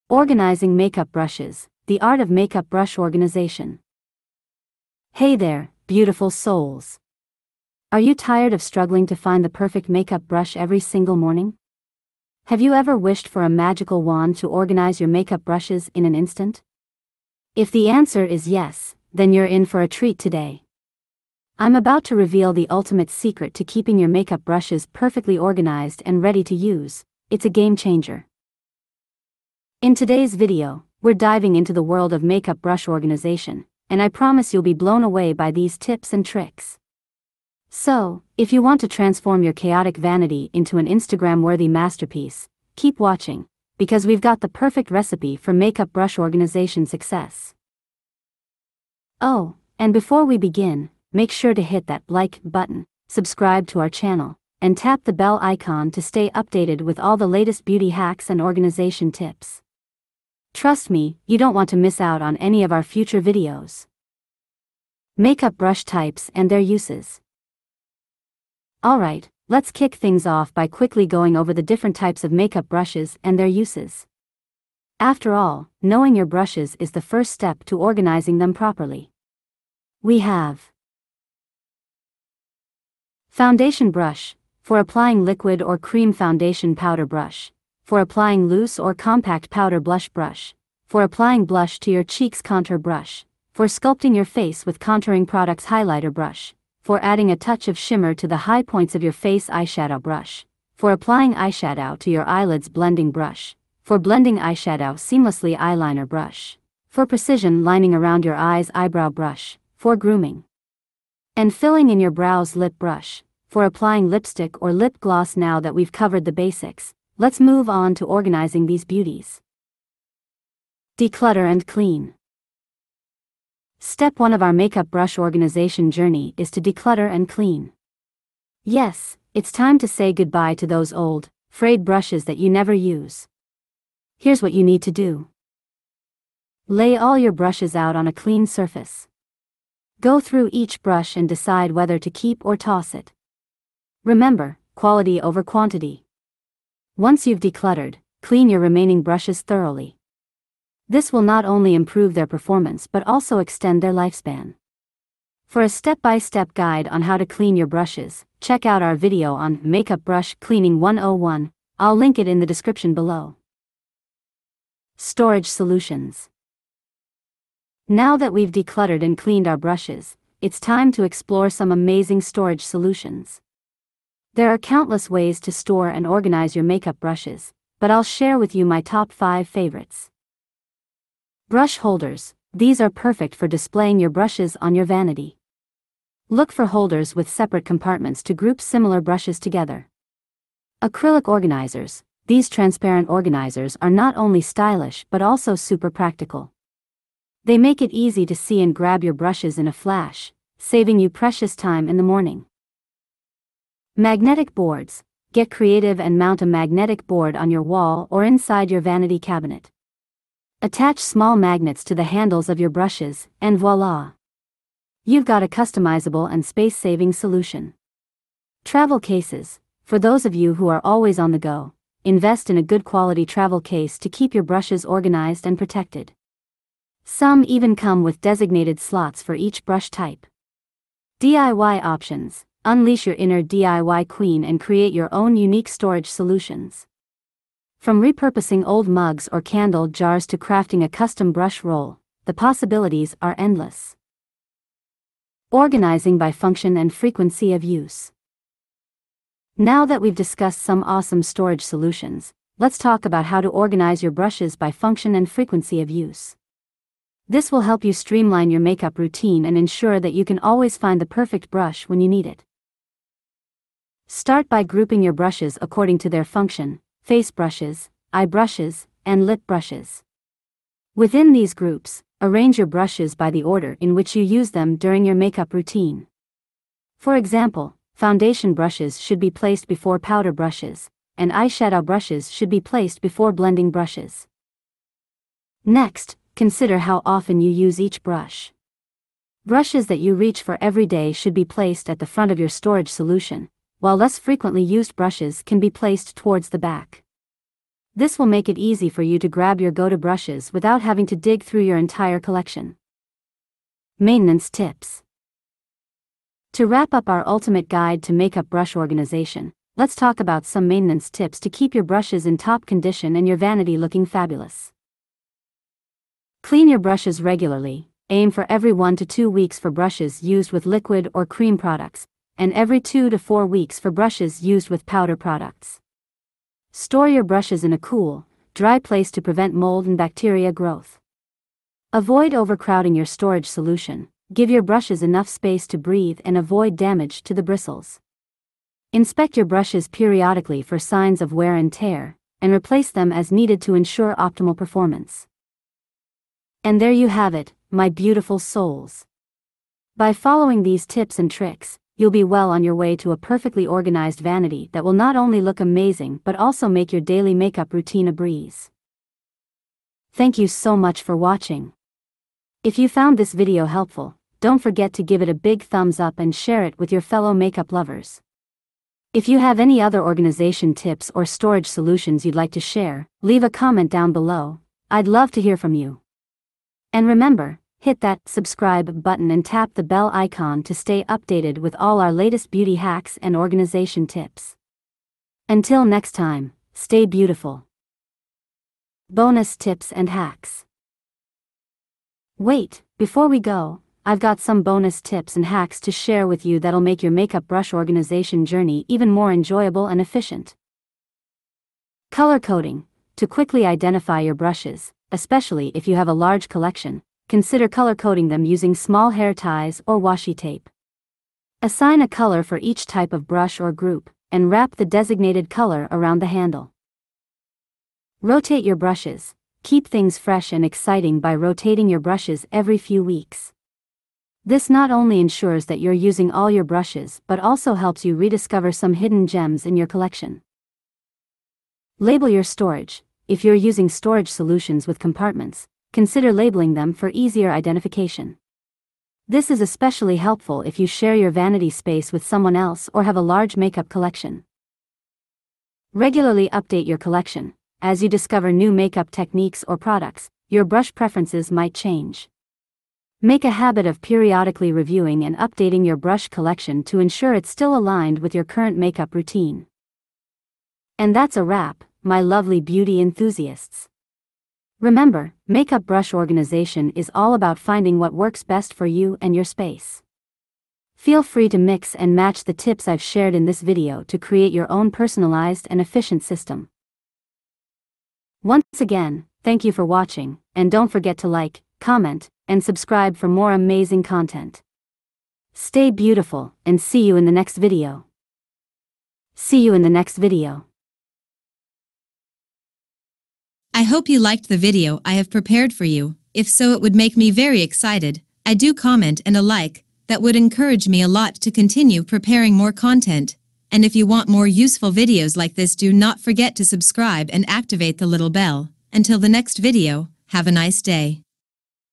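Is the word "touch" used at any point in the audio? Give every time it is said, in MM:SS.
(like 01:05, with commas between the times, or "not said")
01:37.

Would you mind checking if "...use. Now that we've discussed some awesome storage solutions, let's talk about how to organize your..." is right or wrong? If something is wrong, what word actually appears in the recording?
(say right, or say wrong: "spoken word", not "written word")
right.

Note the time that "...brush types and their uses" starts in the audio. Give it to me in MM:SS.
01:05.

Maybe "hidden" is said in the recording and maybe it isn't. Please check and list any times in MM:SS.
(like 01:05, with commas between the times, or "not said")
07:08.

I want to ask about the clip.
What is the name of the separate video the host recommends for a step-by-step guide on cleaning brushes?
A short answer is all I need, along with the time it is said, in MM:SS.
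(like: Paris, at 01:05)
Makeup Brush Cleaning 101, at 02:39.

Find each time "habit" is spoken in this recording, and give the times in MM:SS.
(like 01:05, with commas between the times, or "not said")
07:33.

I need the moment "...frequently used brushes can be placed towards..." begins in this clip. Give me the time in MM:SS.
04:54.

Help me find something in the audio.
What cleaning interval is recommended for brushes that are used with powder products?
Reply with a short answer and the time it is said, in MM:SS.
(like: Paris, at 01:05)
every 2 to 4 weeks, at 05:22.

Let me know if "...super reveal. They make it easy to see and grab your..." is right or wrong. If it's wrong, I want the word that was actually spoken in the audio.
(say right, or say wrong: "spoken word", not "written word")
wrong: "practical", not "reveal".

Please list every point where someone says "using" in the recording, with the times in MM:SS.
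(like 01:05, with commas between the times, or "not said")
06:48, 07:06, 07:13.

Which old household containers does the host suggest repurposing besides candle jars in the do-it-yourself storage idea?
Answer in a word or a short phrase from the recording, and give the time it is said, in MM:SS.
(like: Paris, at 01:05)
old mugs, at 03:58.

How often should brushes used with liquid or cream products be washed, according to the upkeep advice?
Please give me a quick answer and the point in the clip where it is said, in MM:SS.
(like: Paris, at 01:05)
every 1 to 2 weeks, at 05:18.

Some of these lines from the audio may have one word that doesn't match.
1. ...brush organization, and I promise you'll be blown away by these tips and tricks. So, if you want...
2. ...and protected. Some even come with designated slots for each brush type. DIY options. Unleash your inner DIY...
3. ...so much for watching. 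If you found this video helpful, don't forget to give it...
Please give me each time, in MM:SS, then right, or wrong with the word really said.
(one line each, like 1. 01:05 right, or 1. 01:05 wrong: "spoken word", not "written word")
1. 00:32 right
2. 03:45 right
3. 06:00 right.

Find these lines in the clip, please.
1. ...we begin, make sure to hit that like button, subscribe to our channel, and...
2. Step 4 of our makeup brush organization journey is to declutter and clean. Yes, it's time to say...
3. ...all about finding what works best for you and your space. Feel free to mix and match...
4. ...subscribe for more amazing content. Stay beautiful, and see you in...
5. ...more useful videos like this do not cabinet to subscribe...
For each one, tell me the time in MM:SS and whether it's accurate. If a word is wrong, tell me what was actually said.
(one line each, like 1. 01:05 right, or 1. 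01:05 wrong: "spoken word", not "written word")
1. 00:50 right
2. 02:03 wrong: "1", not "4"
3. 07:47 right
4. 08:02 right
5. 08:24 wrong: "forget", not "cabinet".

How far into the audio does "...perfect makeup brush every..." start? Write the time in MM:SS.
00:09.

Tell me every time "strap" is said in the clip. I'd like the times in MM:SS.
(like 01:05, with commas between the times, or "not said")
not said.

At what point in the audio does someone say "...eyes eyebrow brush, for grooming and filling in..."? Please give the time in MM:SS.
01:48.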